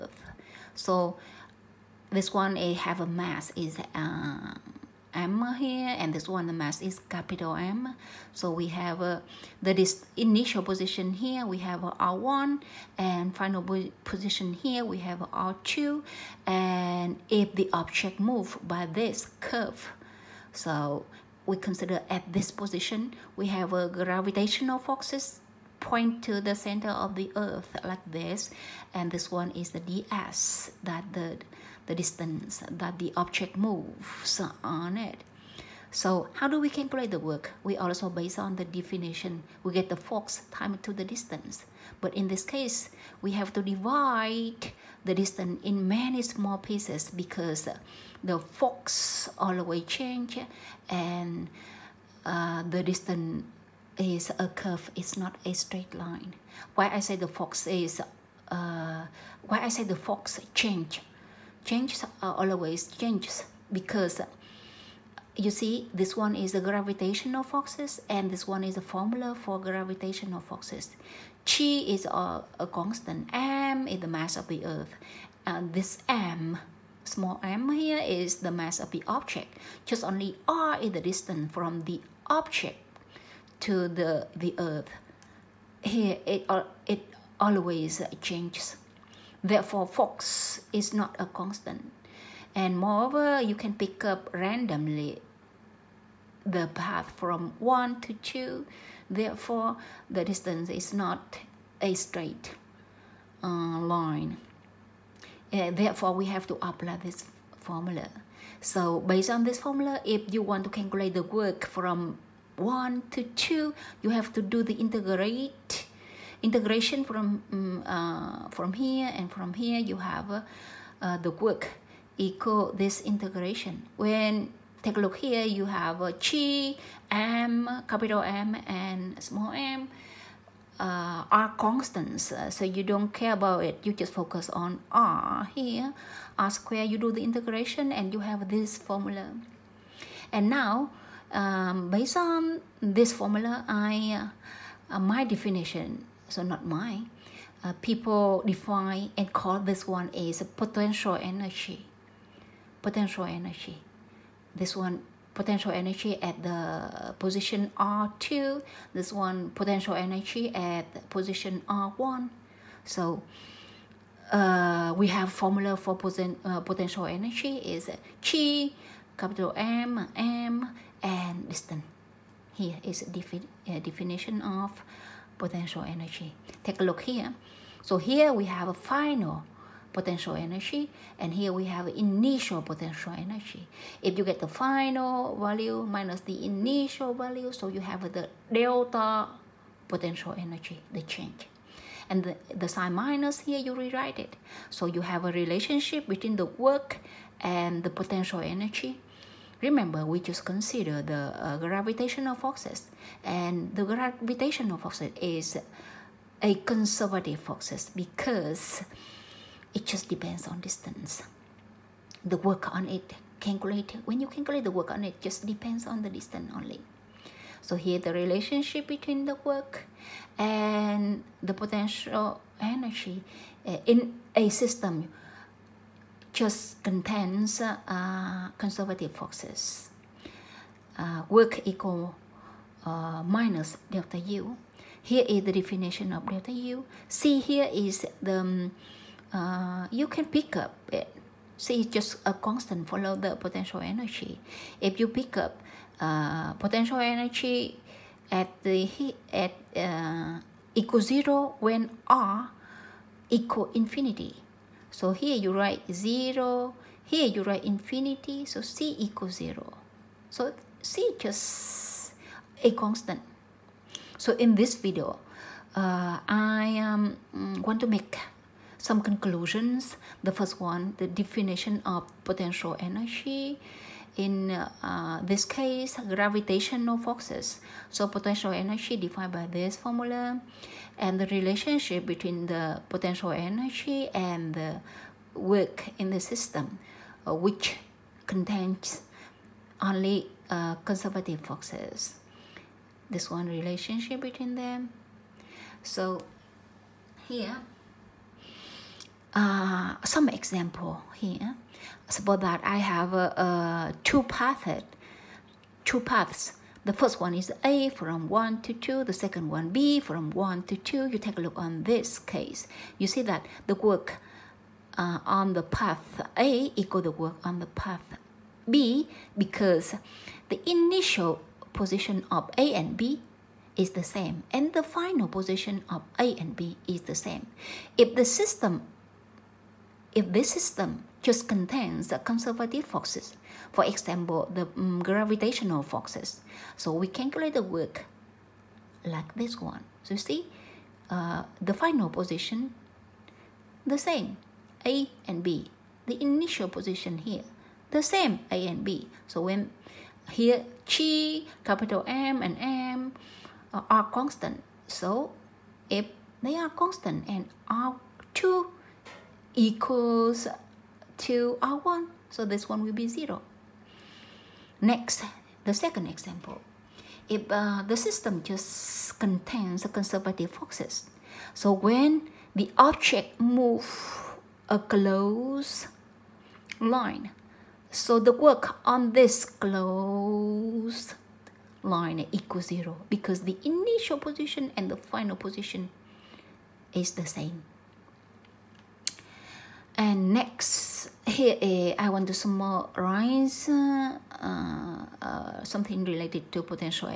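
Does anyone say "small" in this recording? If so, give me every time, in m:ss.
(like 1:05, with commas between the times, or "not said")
0:46, 1:17, 2:09.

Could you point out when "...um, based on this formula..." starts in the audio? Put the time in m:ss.
2:21.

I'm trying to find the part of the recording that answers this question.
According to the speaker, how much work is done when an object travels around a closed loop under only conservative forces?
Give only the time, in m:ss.
6:22.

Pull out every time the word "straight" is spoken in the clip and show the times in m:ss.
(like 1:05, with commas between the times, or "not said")
0:55, 1:41.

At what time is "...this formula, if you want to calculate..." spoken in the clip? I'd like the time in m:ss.
1:49.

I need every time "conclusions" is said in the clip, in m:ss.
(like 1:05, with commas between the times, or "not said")
4:29.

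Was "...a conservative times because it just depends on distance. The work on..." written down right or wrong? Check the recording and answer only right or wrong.
wrong.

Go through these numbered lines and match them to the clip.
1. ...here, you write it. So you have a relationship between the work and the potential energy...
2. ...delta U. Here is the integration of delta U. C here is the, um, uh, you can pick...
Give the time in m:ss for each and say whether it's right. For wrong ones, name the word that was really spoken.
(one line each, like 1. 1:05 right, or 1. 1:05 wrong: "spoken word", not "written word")
1. 3:13 wrong: "rewrite", not "write"
2. 3:53 wrong: "definition", not "integration".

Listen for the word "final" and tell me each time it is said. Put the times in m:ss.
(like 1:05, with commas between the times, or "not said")
0:13, 2:58, 3:04, 5:24, 5:41, 6:24.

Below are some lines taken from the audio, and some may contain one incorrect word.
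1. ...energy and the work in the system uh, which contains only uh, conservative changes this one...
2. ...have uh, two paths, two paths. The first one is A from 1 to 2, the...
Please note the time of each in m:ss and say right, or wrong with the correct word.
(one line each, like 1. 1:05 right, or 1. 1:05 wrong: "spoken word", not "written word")
1. 4:43 wrong: "forces", not "changes"
2. 5:02 right.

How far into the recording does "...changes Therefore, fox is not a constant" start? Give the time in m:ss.
1:28.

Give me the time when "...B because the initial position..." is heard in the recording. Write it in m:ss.
5:18.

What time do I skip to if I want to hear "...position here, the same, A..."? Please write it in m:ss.
5:46.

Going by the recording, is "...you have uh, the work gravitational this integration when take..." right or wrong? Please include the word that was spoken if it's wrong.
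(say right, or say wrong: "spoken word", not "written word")
wrong: "equal", not "gravitational".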